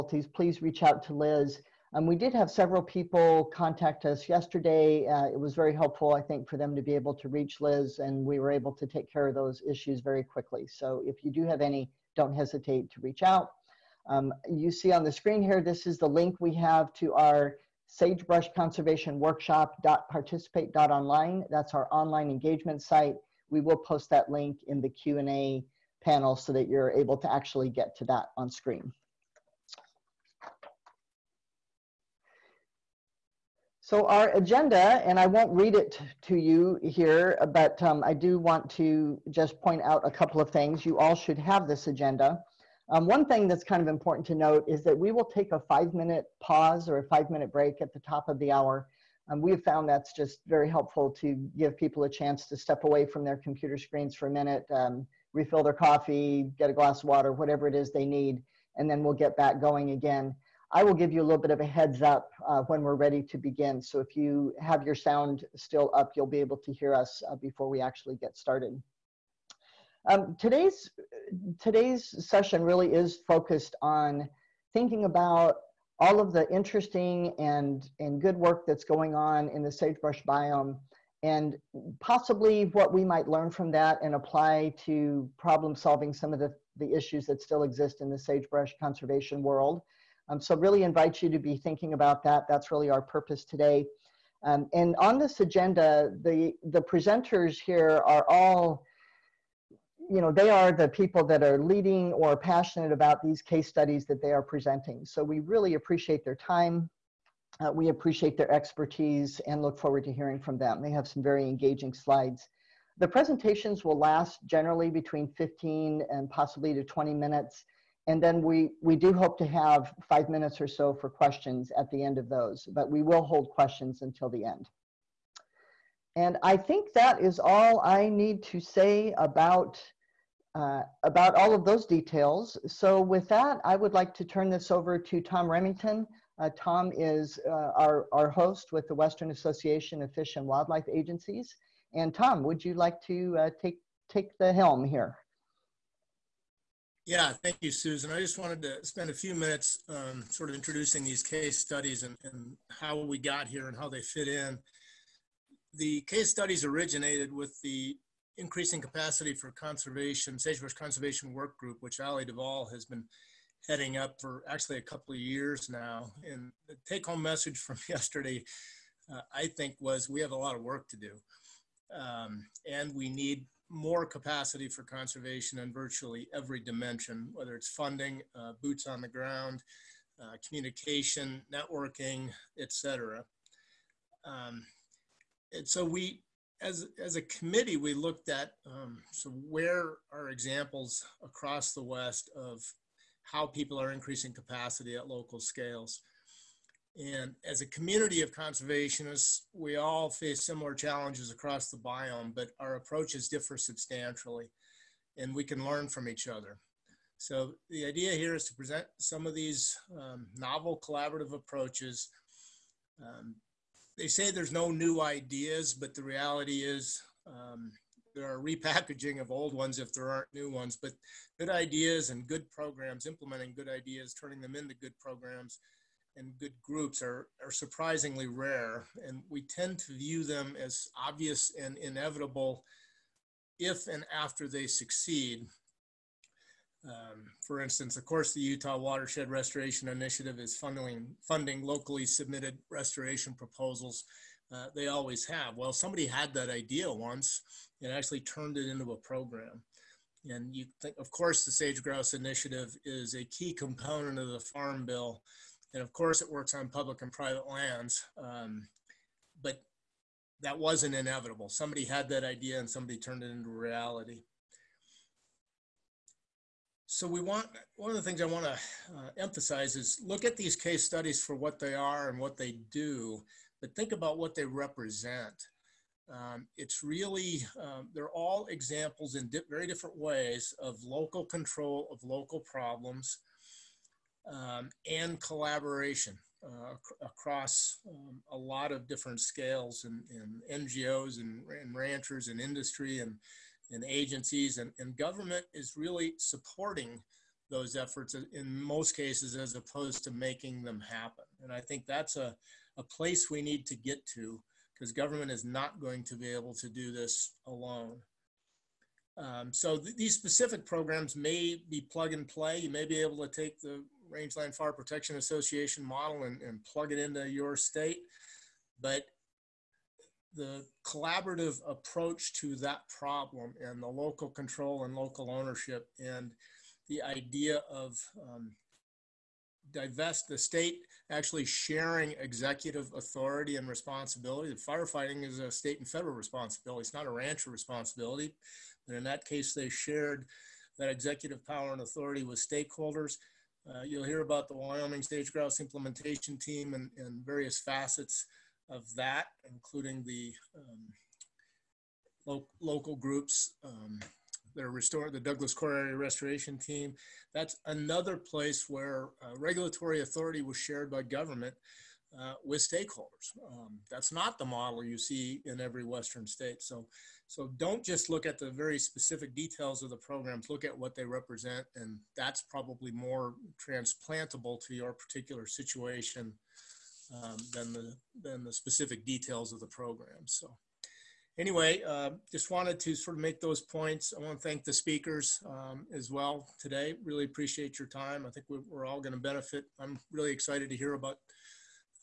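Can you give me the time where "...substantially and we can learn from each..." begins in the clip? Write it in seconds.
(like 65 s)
203 s.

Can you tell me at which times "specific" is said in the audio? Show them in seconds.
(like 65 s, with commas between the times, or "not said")
310 s, 368 s, 378 s.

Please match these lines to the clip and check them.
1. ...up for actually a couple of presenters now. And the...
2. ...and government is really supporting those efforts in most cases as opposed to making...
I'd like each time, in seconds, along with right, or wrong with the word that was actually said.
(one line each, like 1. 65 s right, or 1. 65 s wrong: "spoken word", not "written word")
1. 163 s wrong: "years", not "presenters"
2. 294 s right.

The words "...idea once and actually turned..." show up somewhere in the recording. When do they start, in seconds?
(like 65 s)
246 s.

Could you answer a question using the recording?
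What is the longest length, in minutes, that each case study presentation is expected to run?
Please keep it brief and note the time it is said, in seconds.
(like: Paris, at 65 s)
20, at 116 s.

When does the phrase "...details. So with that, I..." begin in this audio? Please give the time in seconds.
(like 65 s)
131 s.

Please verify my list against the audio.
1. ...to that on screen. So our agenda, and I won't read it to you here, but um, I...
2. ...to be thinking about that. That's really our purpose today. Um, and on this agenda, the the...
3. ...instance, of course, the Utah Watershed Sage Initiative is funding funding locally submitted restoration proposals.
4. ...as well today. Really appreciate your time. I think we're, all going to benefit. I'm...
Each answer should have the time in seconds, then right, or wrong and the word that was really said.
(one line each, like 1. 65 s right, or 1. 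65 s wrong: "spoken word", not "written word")
1. 27 s right
2. 91 s right
3. 237 s wrong: "Restoration", not "Sage"
4. 385 s right.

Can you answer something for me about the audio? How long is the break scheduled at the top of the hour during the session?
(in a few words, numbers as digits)
5 minutes.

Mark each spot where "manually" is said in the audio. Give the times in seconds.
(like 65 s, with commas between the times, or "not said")
not said.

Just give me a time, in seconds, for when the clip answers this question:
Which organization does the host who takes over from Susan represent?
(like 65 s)
138 s.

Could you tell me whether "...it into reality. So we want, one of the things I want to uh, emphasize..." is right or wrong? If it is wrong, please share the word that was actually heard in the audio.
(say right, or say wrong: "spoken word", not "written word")
right.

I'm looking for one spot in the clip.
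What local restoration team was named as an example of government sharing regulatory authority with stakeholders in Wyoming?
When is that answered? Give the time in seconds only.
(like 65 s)
355 s.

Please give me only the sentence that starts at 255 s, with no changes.
And of course, it works on public and private lands.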